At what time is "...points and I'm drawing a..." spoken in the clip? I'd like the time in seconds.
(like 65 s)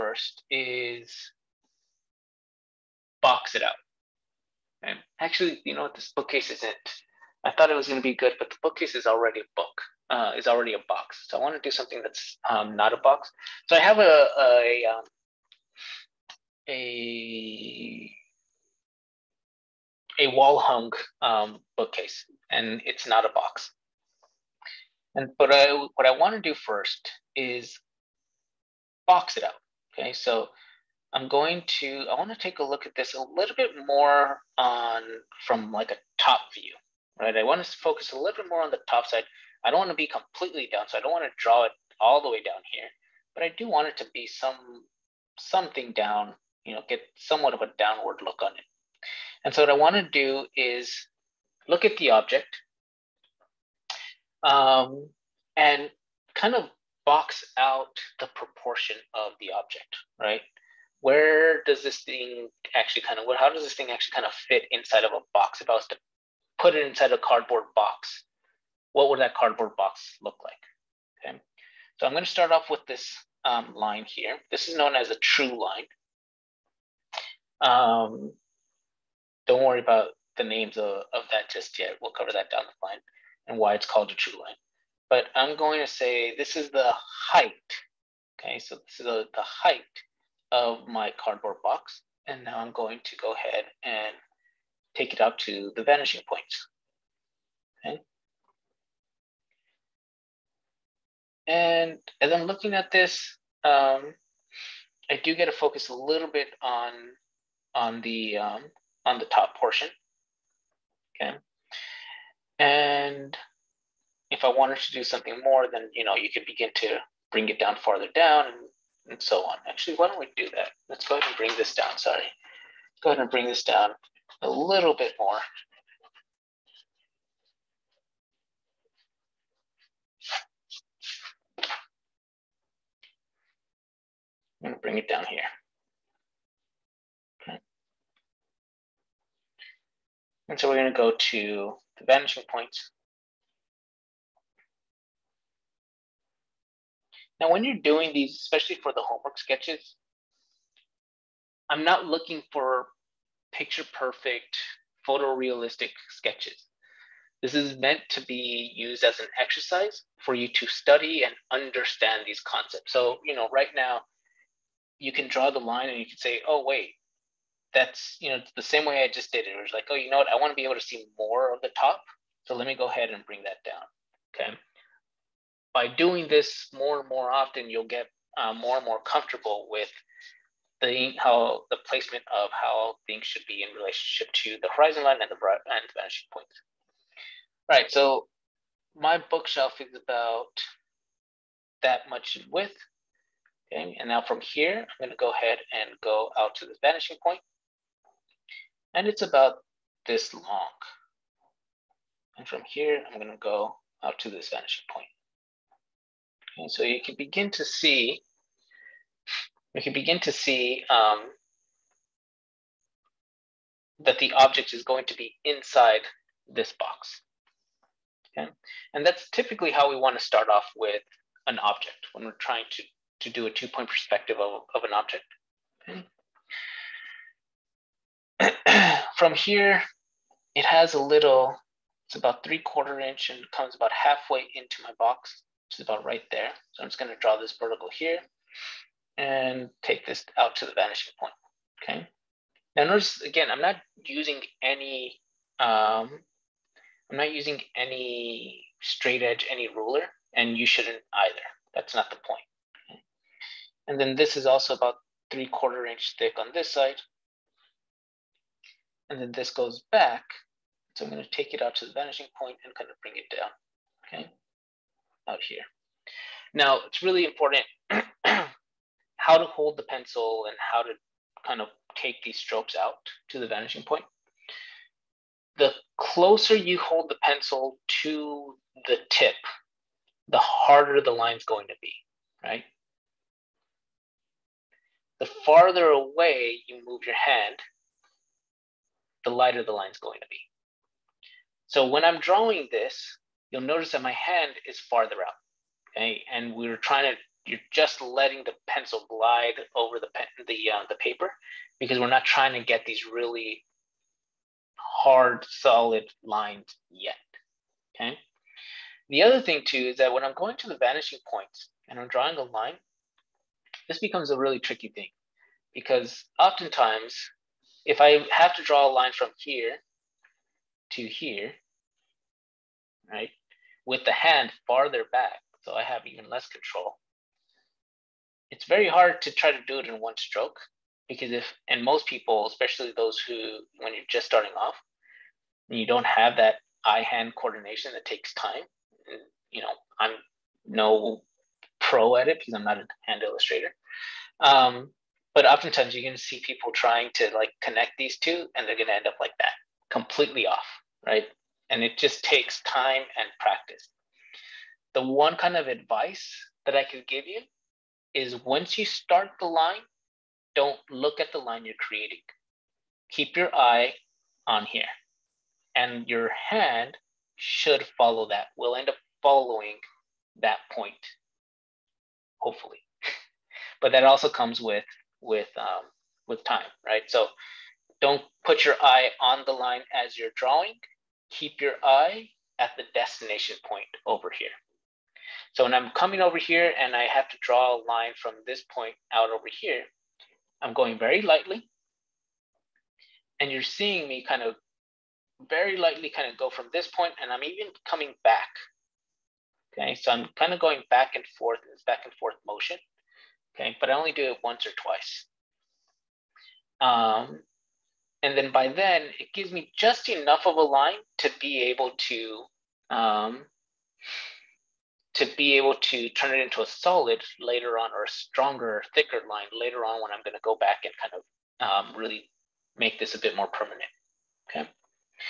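311 s.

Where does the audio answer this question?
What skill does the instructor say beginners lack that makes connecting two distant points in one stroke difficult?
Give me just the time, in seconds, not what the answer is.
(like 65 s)
336 s.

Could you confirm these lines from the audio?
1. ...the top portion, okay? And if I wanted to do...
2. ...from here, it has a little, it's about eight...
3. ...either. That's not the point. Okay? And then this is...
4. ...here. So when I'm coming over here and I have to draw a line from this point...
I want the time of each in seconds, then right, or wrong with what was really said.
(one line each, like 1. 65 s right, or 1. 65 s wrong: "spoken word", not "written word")
1. 109 s right
2. 229 s wrong: "three", not "eight"
3. 251 s right
4. 384 s right.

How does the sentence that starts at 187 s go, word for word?
So my bookshelf is about that much width.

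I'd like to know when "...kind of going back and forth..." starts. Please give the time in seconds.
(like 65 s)
400 s.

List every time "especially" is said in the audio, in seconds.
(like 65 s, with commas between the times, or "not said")
148 s, 332 s.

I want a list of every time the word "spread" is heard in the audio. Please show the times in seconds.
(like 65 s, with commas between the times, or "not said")
not said.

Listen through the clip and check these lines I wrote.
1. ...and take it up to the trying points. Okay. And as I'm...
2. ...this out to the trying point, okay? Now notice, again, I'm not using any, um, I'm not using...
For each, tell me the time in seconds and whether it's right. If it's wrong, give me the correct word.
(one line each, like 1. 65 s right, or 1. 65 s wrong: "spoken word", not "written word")
1. 93 s wrong: "vanishing", not "trying"
2. 240 s wrong: "vanishing", not "trying".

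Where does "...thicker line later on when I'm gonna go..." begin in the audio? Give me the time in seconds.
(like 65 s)
418 s.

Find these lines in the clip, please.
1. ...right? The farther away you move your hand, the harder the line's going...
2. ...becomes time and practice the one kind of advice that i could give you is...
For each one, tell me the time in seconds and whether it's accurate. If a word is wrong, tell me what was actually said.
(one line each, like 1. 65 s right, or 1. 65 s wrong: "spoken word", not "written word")
1. 282 s wrong: "lighter", not "harder"
2. 352 s wrong: "takes", not "becomes".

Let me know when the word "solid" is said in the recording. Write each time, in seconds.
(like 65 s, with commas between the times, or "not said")
305 s, 416 s.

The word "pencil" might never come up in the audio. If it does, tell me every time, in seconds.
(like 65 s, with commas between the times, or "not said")
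269 s, 277 s, 298 s.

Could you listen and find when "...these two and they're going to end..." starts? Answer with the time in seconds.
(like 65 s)
347 s.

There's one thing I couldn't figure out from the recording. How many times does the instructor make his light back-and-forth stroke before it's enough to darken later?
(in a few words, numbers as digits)
Once or twice.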